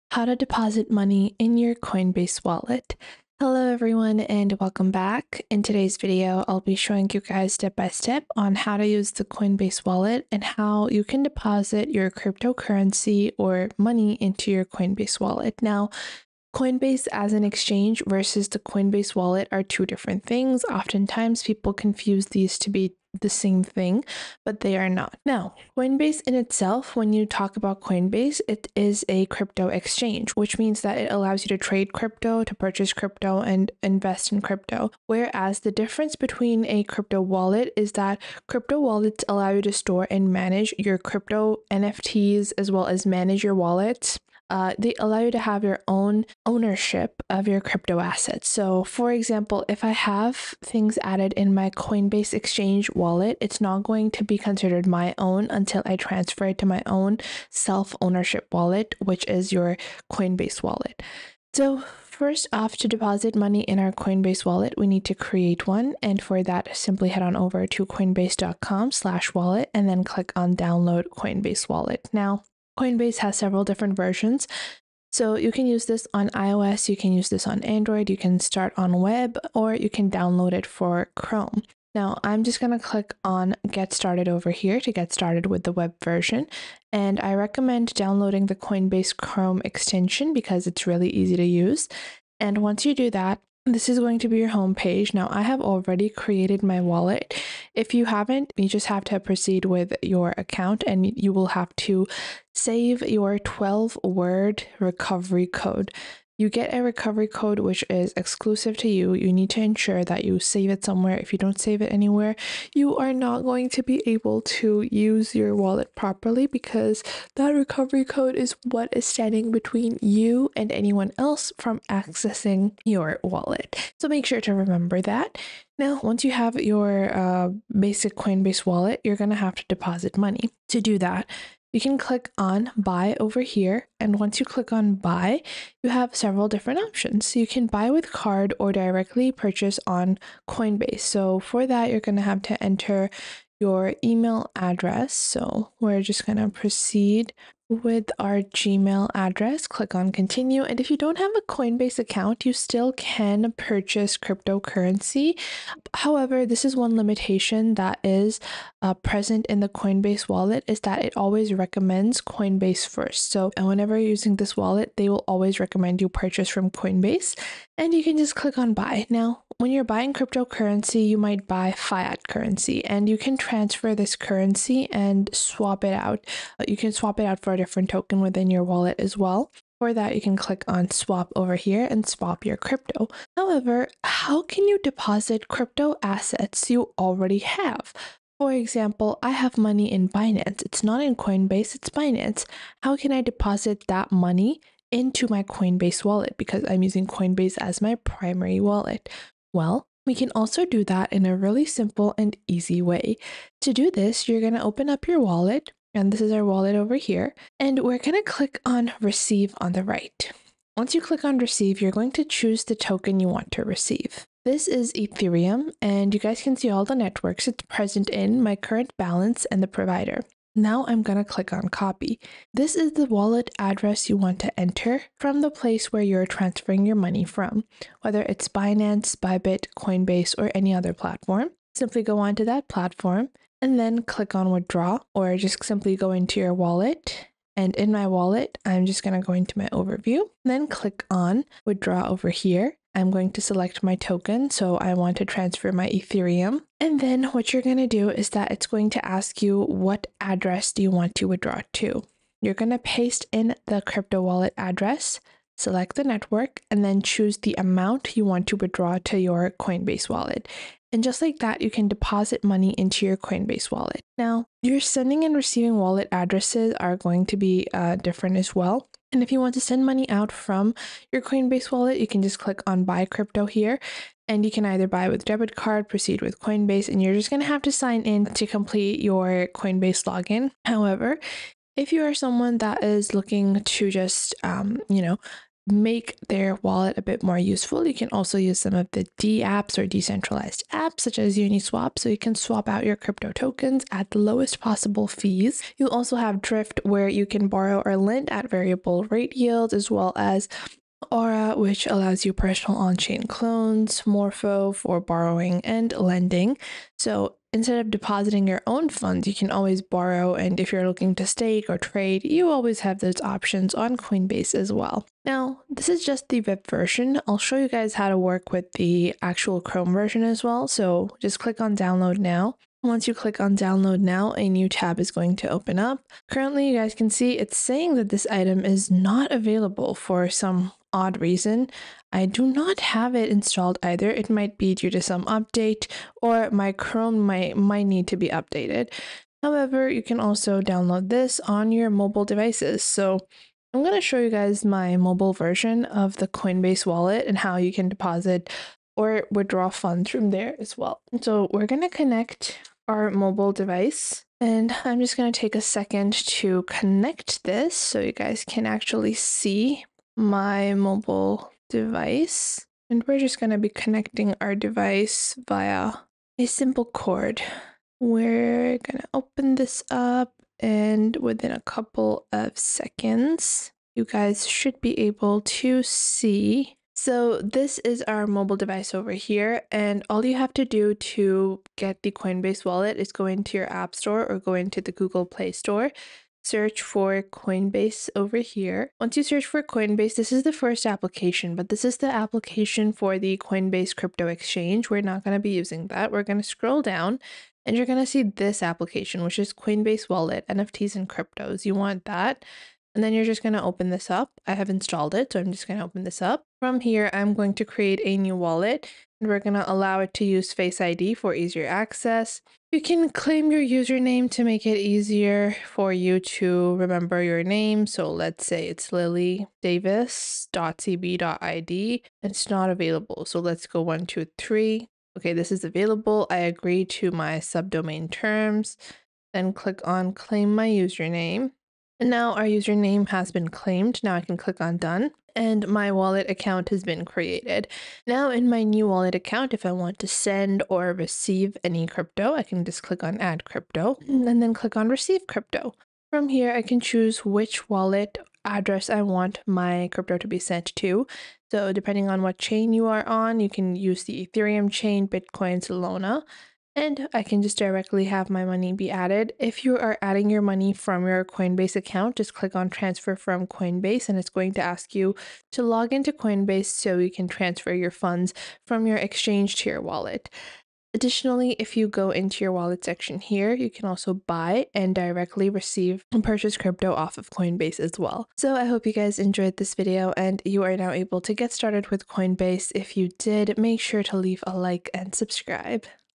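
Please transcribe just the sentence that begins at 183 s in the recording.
However, how can you deposit crypto assets you already have?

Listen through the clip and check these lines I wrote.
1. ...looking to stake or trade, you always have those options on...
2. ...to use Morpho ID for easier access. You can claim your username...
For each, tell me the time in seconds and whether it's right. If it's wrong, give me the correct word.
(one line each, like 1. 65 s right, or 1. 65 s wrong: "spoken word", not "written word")
1. 310 s right
2. 410 s wrong: "Face", not "Morpho".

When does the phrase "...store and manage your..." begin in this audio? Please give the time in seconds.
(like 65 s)
39 s.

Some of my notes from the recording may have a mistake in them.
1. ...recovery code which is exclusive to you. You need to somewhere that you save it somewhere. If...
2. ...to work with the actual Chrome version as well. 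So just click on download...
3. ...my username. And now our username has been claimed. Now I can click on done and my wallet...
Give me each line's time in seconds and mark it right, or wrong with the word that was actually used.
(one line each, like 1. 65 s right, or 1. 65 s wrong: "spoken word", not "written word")
1. 106 s wrong: "ensure", not "somewhere"
2. 318 s right
3. 430 s right.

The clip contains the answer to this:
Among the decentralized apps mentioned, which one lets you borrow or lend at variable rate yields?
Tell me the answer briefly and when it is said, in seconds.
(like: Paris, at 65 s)
Drift, at 296 s.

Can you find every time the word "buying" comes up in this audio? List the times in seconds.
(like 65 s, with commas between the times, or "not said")
169 s.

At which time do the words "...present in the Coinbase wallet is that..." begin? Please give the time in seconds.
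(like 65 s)
158 s.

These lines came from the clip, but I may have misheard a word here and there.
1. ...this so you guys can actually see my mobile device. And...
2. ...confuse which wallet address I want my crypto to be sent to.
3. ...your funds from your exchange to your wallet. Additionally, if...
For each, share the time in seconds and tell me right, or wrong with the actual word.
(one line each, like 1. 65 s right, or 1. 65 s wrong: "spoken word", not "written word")
1. 357 s right
2. 446 s wrong: "choose", not "confuse"
3. 467 s right.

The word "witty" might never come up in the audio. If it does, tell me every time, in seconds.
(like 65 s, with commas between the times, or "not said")
not said.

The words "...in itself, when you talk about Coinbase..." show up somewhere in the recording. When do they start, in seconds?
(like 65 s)
26 s.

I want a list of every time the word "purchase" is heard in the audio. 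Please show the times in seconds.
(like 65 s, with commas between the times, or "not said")
32 s, 139 s, 153 s, 166 s, 476 s.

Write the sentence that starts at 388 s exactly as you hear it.
Once you search for Coinbase, this is the first application, but this is the application for the Coinbase crypto exchange.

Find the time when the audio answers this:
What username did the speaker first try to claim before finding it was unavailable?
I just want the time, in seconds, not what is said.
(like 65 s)
419 s.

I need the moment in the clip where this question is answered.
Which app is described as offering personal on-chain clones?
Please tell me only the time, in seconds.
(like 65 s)
301 s.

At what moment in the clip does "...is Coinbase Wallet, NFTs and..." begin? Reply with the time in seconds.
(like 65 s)
399 s.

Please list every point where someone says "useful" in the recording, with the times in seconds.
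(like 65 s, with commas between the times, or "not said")
287 s.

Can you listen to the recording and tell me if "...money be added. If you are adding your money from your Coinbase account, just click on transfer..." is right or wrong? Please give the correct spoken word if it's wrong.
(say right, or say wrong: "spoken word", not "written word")
right.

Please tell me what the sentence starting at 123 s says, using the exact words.
So make sure to remember that.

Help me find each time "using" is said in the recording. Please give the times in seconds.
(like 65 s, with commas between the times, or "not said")
164 s, 196 s, 395 s.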